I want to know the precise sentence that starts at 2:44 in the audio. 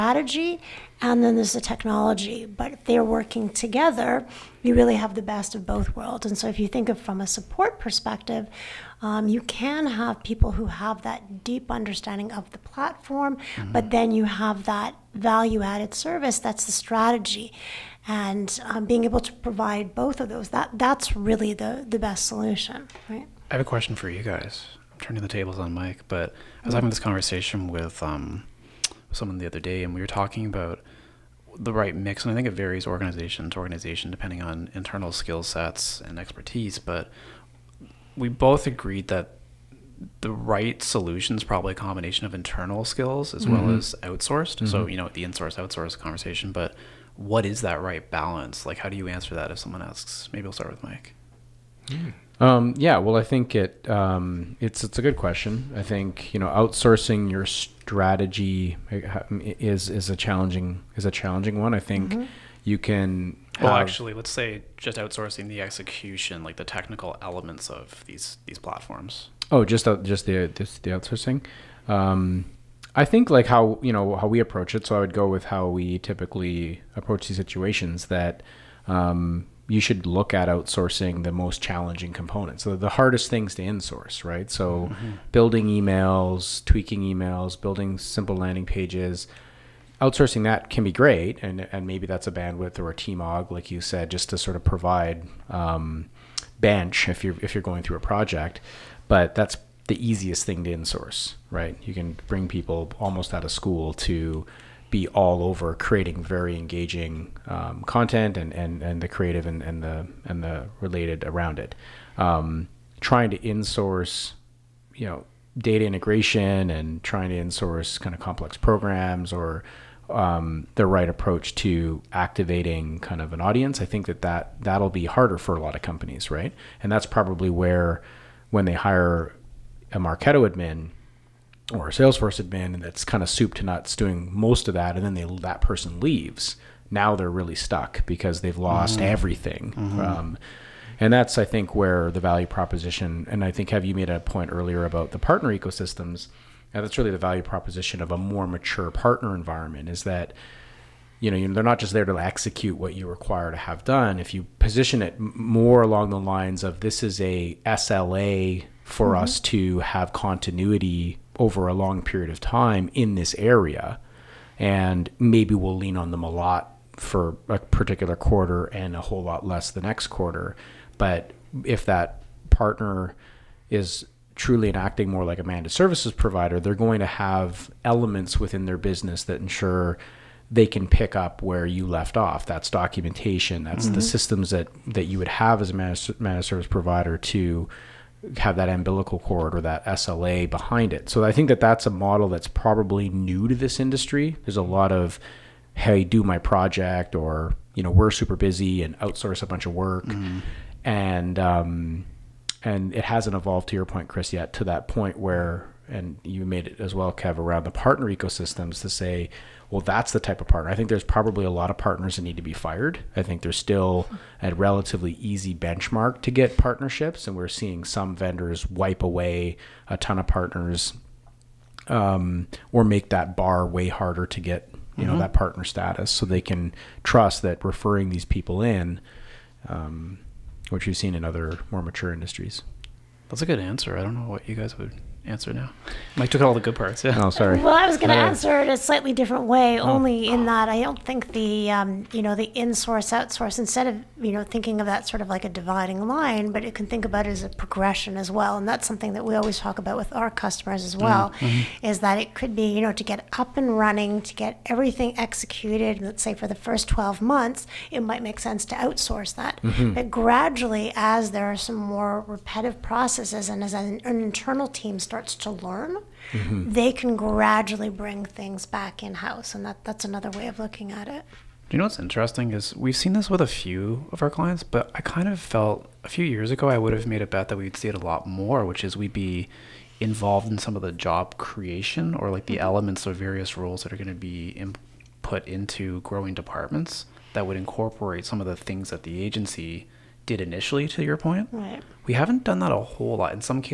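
And maybe we'll lean on them a lot for a particular quarter and a whole lot less the next quarter.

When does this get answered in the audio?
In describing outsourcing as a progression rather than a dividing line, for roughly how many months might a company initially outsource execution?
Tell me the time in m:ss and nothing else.
4:16.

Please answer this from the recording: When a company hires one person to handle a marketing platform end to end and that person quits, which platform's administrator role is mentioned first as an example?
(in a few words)
Marketo.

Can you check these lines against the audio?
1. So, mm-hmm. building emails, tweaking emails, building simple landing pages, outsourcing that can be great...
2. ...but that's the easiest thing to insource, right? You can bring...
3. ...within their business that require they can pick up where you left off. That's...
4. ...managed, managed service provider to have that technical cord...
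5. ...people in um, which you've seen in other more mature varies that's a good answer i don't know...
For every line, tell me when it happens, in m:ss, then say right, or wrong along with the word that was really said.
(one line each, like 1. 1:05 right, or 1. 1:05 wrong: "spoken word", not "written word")
1. 1:24 right
2. 1:39 right
3. 2:58 wrong: "ensure", not "require"
4. 3:05 wrong: "umbilical", not "technical"
5. 3:48 wrong: "industries", not "varies".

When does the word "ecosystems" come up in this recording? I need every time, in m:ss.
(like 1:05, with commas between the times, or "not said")
2:25, 3:28.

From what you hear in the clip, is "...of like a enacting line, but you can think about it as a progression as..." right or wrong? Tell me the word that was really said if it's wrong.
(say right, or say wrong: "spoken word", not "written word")
wrong: "dividing", not "enacting".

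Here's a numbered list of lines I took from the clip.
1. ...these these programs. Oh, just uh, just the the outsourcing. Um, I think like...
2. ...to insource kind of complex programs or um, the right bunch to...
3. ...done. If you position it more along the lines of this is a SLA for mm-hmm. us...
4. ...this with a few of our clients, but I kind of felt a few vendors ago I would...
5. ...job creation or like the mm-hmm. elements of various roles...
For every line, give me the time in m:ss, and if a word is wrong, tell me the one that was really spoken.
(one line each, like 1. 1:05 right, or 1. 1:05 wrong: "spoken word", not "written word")
1. 1:08 wrong: "platforms", not "programs"
2. 1:57 wrong: "approach", not "bunch"
3. 2:33 right
4. 4:33 wrong: "years", not "vendors"
5. 4:40 right.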